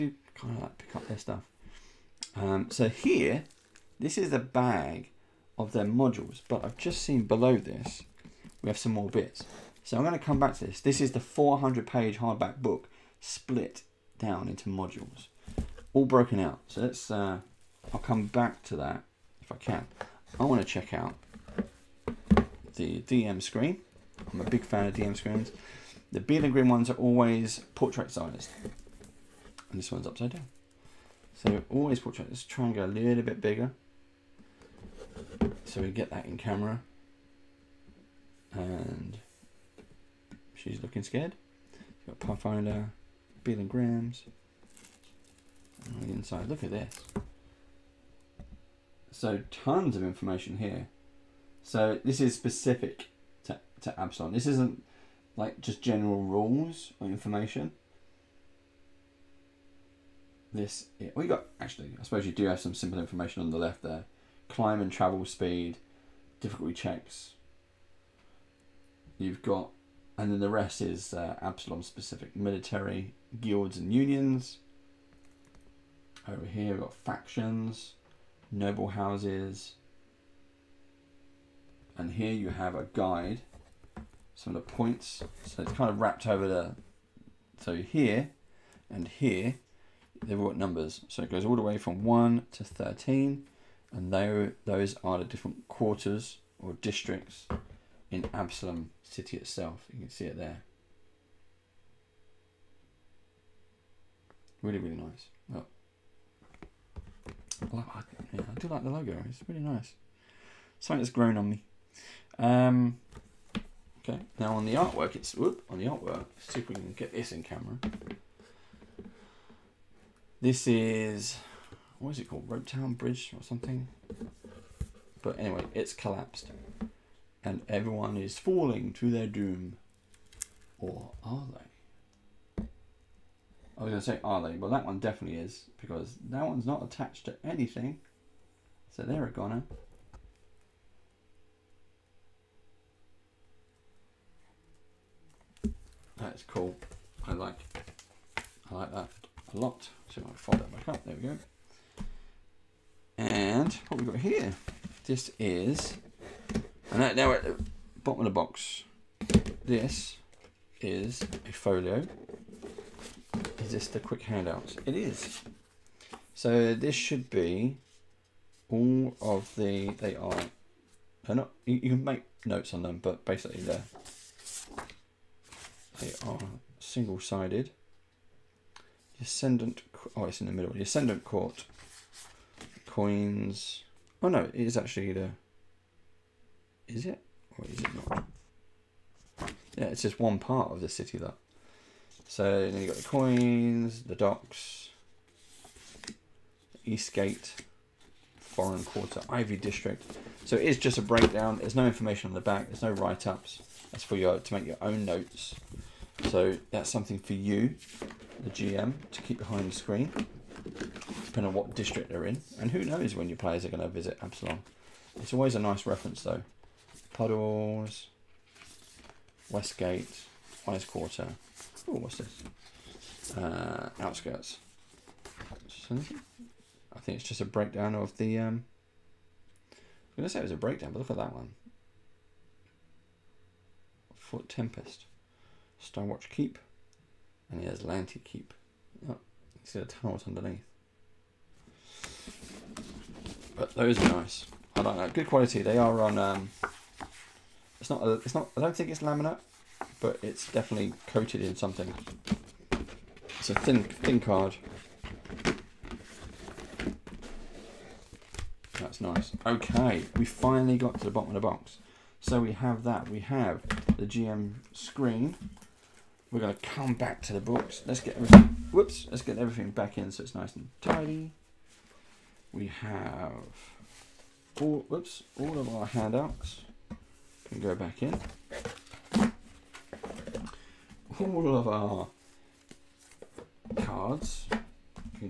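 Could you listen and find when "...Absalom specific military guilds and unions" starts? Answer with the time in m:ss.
1:11.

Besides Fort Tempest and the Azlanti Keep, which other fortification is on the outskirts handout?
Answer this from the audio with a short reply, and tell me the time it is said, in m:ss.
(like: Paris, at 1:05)
Starwatch Keep, at 3:55.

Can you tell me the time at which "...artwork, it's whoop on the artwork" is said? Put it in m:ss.
1:54.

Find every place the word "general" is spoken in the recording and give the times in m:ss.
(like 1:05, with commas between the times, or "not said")
0:55.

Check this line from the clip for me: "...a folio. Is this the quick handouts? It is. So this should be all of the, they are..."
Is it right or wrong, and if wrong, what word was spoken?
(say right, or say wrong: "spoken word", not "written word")
right.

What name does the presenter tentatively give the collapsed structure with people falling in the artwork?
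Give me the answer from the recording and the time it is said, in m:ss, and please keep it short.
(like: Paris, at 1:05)
Rope Town Bridge, at 2:02.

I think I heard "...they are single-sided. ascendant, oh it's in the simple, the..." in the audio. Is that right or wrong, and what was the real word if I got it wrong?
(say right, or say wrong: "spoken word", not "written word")
wrong: "middle", not "simple".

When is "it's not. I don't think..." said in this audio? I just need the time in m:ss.
4:08.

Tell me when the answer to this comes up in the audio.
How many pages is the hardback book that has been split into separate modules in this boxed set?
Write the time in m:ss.
0:11.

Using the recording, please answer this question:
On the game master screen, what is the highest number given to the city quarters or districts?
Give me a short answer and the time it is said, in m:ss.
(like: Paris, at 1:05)
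13, at 1:32.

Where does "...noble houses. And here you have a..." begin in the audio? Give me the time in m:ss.
1:18.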